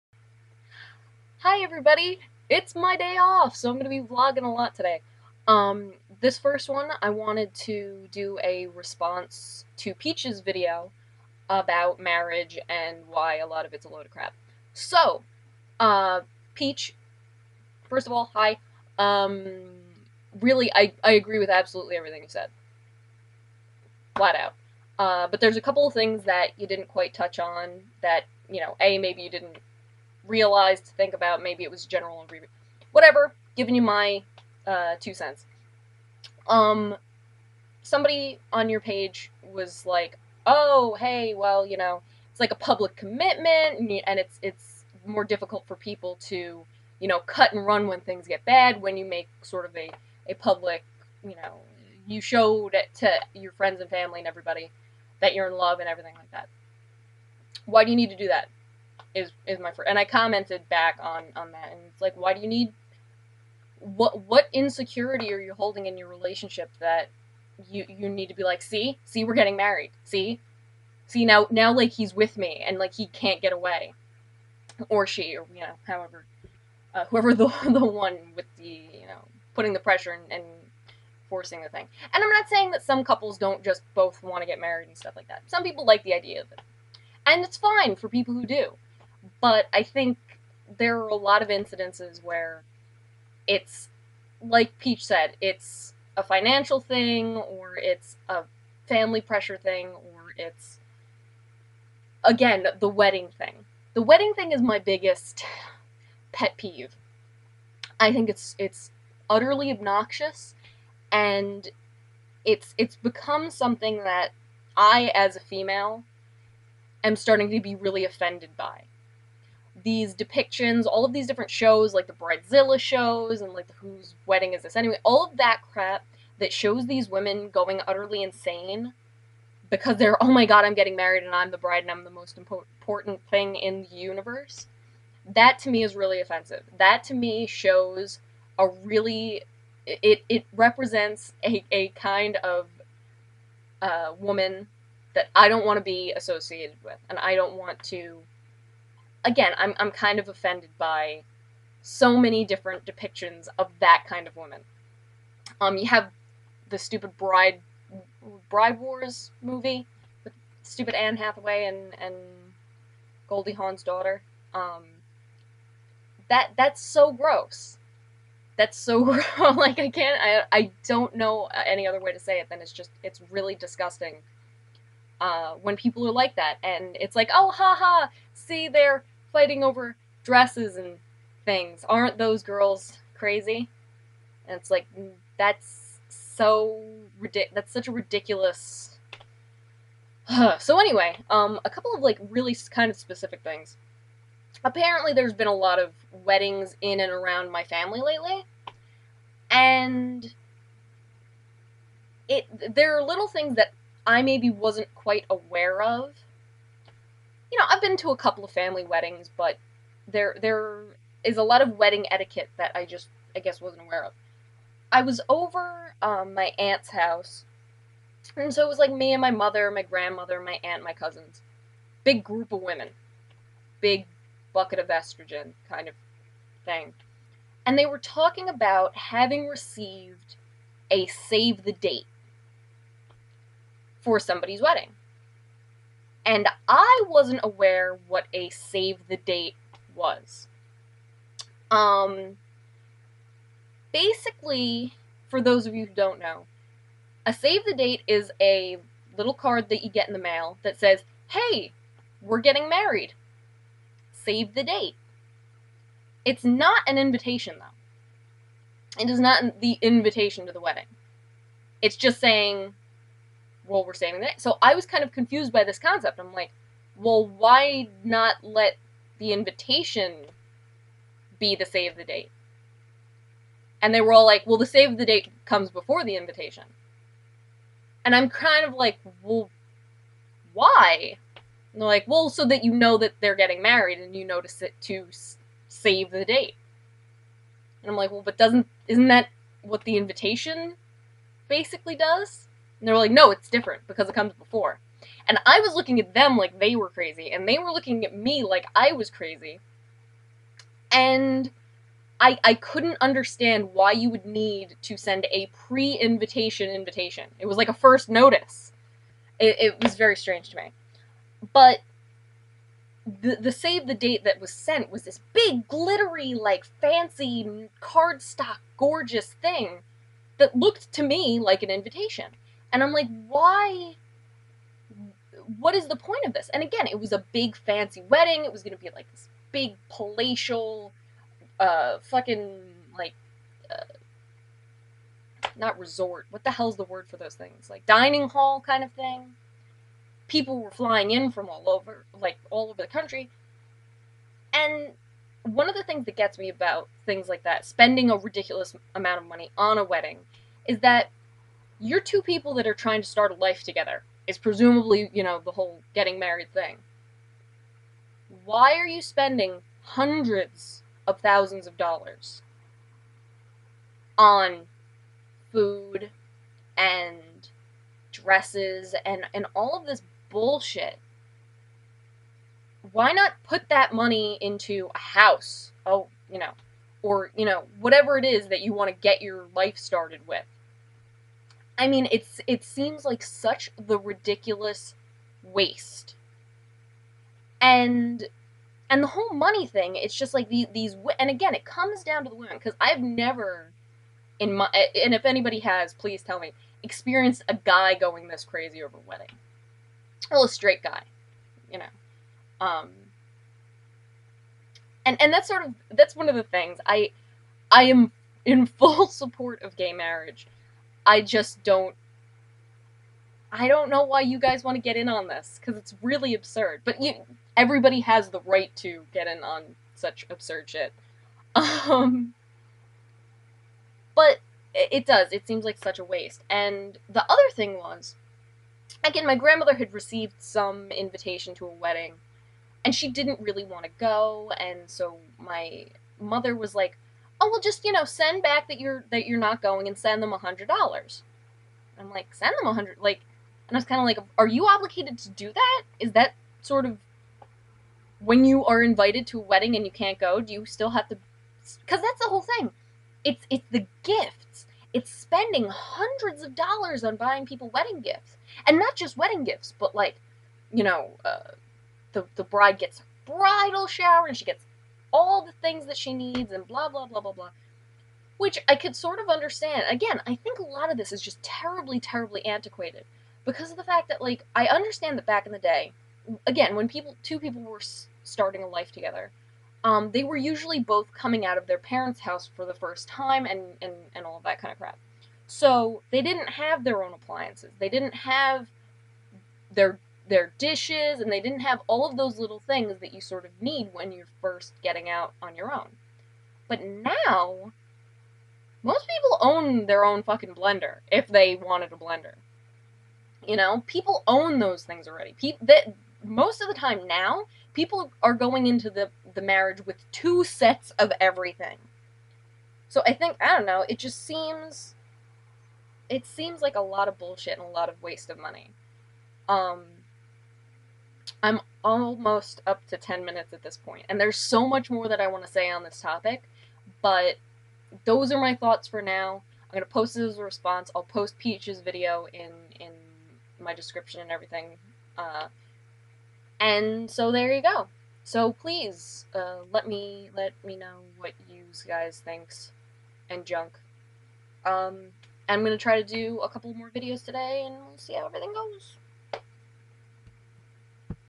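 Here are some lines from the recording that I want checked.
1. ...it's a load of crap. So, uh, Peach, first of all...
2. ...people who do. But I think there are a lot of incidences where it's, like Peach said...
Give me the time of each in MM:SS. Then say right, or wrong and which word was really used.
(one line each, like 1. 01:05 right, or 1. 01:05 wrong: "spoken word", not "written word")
1. 00:13 right
2. 01:28 right.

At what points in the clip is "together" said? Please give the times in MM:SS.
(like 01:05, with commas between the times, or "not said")
05:53, 07:58.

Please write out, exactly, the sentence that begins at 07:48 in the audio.
Which I could sort of understand.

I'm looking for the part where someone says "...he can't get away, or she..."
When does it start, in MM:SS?
01:12.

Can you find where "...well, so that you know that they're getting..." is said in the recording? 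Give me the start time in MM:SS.
04:42.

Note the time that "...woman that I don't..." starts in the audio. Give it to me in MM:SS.
02:24.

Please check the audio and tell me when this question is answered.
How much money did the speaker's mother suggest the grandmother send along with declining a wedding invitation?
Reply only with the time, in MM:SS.
07:20.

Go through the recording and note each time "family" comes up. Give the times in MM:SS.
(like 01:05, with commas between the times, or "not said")
00:53, 01:38, 03:17, 03:28.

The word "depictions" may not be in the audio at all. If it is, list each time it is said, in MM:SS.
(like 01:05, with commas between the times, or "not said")
02:00, 02:32.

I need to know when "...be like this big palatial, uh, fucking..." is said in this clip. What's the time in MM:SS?
05:28.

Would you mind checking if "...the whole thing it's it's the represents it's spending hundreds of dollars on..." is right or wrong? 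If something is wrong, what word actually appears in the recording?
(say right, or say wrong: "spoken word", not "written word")
wrong: "gifts", not "represents".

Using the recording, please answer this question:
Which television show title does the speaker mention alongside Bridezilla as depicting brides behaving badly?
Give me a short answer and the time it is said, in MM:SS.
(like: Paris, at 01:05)
Whose Wedding Is This Anyway, at 02:03.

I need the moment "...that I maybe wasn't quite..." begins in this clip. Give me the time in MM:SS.
03:23.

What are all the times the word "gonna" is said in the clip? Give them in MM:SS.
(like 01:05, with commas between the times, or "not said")
08:49, 09:05.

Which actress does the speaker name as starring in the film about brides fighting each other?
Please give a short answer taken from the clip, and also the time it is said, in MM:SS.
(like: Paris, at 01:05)
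Anne Hathaway, at 02:40.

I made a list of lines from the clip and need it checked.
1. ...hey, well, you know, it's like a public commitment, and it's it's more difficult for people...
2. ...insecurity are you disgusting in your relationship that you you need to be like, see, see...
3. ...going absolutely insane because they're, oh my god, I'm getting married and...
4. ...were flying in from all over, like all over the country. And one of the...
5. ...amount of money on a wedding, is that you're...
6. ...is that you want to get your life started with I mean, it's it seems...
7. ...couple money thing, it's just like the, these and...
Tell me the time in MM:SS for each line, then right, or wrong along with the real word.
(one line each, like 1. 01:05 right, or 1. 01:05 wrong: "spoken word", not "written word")
1. 00:40 right
2. 01:04 wrong: "holding", not "disgusting"
3. 02:07 wrong: "utterly", not "absolutely"
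4. 05:40 right
5. 05:48 right
6. 06:18 right
7. 06:29 wrong: "whole", not "couple".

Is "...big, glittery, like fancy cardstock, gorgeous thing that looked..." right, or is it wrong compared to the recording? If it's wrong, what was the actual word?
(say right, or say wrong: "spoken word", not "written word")
right.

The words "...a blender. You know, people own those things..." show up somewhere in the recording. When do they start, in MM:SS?
08:21.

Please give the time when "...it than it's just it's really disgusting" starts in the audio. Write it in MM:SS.
02:52.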